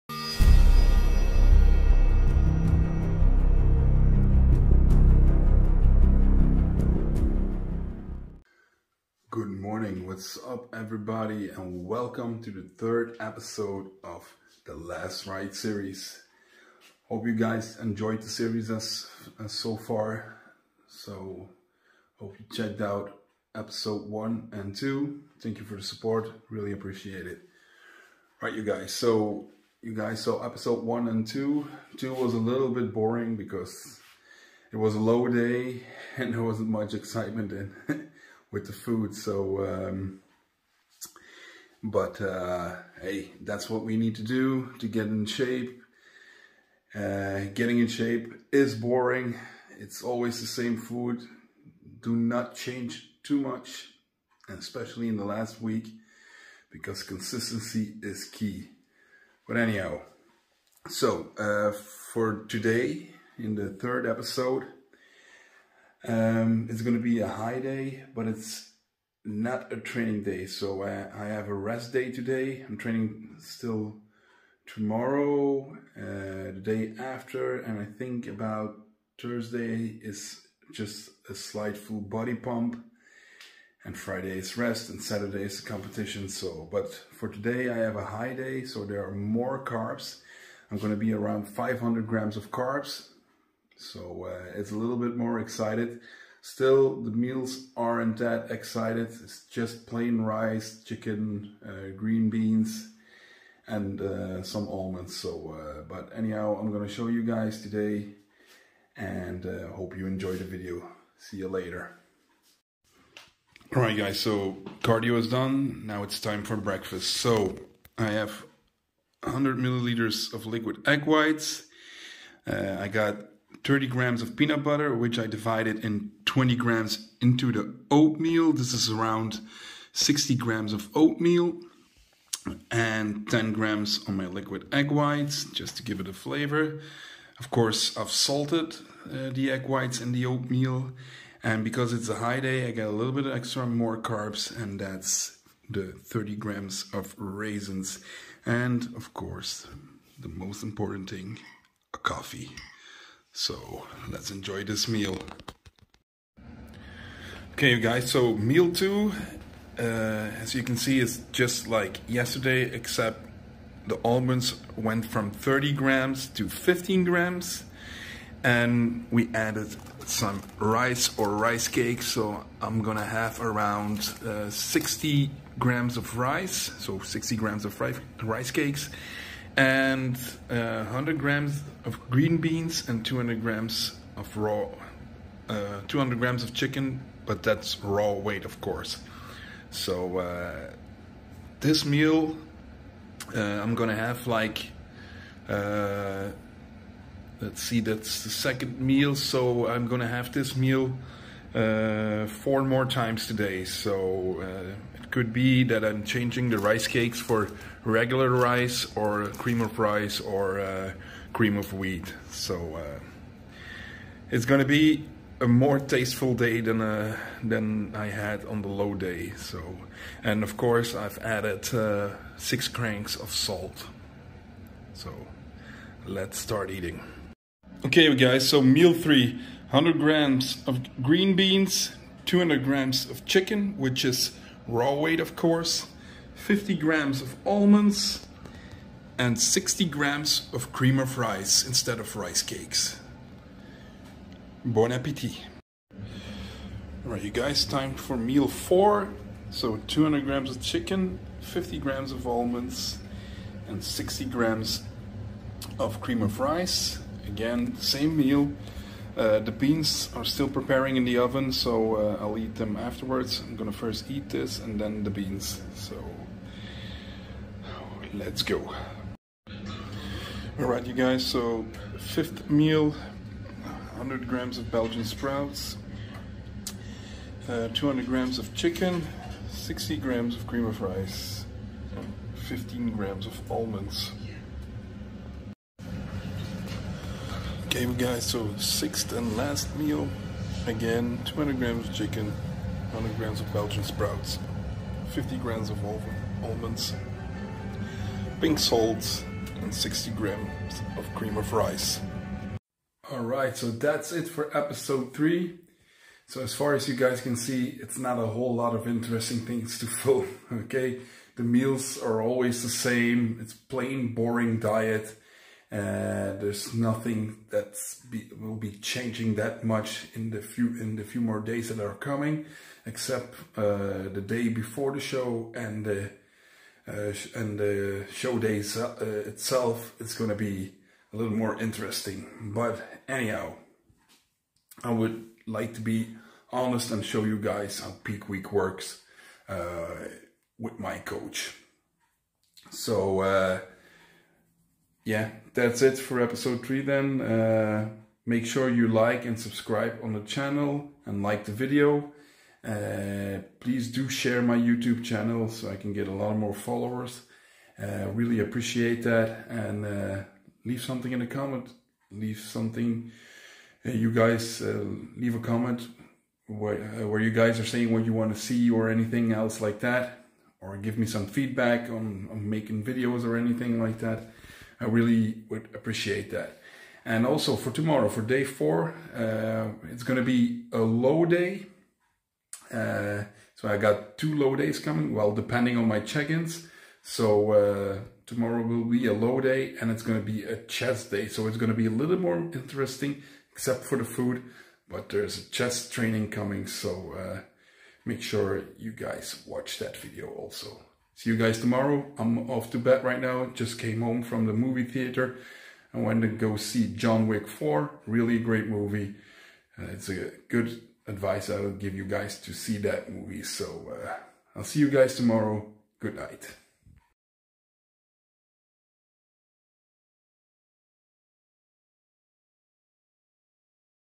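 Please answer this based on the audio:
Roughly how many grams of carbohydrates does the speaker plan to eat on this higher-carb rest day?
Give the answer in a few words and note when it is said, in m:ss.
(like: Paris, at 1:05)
500 grams, at 1:31.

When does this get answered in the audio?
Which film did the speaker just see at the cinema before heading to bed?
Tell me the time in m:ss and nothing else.
6:46.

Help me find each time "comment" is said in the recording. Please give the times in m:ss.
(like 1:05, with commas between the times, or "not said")
6:01, 6:05.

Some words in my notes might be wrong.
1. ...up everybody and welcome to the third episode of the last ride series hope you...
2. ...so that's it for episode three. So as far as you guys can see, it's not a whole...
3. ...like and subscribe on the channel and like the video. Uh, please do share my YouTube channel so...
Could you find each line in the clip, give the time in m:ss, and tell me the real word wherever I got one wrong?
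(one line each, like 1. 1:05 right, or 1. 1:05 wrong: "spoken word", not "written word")
1. 0:10 right
2. 5:03 right
3. 5:48 right.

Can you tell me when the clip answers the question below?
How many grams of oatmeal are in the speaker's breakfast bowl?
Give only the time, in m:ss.
2:09.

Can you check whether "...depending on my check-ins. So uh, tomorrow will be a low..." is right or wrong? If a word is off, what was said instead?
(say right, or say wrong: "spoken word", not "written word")
right.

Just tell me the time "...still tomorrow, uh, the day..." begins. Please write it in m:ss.
1:13.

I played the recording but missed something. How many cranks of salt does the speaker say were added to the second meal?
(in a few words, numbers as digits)
6.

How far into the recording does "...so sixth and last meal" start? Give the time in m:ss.
4:48.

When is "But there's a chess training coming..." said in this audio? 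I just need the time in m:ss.
6:34.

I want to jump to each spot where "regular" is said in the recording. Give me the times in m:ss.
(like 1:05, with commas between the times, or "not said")
3:27.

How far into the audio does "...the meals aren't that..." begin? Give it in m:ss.
1:37.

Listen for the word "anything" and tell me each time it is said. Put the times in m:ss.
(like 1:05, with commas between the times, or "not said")
6:08, 6:13.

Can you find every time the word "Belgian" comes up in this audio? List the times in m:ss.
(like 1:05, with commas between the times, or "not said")
4:34, 4:53.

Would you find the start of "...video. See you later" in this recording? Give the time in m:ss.
1:50.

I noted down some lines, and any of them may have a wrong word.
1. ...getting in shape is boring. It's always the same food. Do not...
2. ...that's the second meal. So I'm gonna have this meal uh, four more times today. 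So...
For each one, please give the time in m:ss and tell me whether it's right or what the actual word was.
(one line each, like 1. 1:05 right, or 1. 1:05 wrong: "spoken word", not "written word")
1. 0:47 right
2. 3:17 right.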